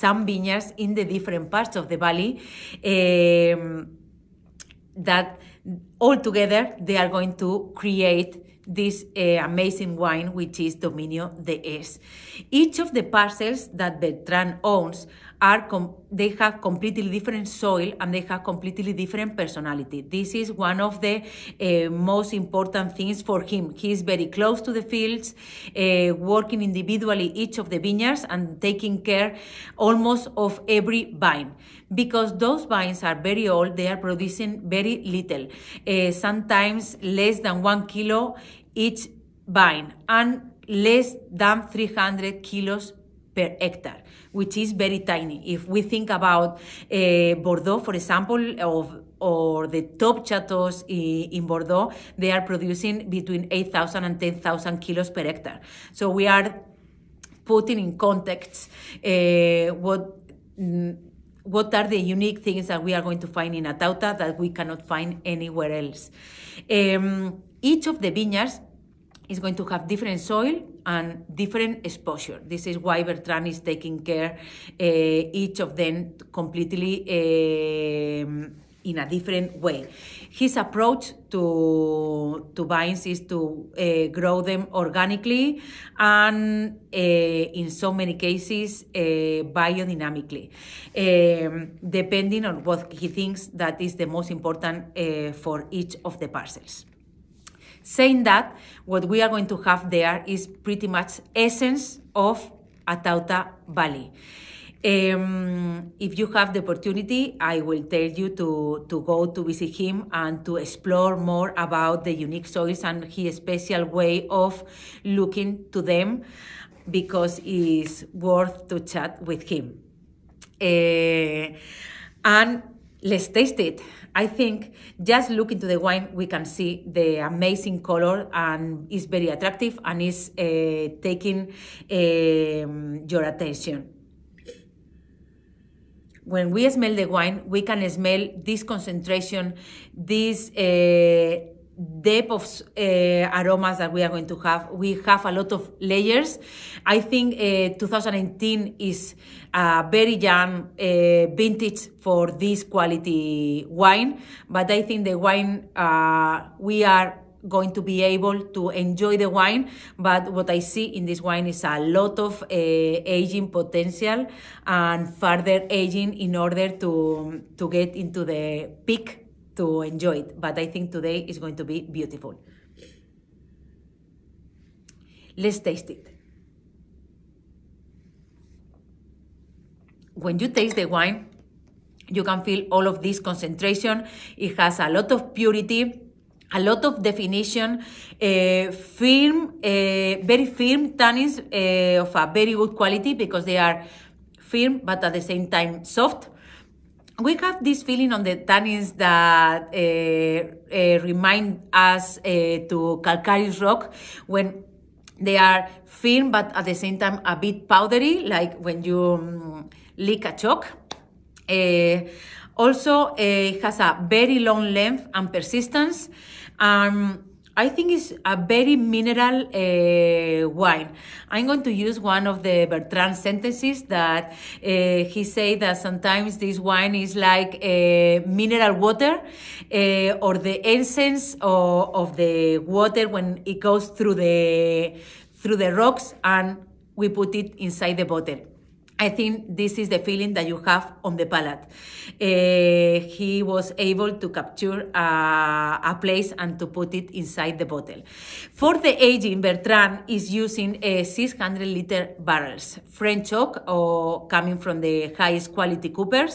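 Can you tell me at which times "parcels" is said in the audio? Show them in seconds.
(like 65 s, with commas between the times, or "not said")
13 s, 96 s.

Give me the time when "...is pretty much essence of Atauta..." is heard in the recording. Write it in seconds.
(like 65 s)
100 s.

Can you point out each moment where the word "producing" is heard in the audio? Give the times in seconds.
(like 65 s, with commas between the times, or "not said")
33 s, 52 s.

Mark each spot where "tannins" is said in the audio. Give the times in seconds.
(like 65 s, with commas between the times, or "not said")
190 s, 198 s.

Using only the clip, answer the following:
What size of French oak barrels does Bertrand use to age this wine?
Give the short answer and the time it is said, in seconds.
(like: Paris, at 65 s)
600 liters, at 251 s.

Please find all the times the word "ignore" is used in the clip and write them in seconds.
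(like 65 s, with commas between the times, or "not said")
not said.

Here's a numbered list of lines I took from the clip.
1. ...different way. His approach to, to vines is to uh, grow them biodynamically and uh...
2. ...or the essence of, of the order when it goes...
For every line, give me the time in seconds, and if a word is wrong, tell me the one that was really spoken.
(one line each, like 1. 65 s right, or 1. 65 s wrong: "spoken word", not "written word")
1. 79 s wrong: "organically", not "biodynamically"
2. 230 s wrong: "water", not "order".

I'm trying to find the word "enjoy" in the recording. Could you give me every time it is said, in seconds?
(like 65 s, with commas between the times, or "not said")
158 s, 169 s.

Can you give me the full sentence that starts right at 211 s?
Uh, also, uh, it has a very long length and persistence.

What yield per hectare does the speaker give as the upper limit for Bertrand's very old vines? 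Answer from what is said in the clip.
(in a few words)
300 kilos.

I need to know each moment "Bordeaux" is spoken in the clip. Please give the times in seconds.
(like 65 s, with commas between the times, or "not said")
47 s, 51 s.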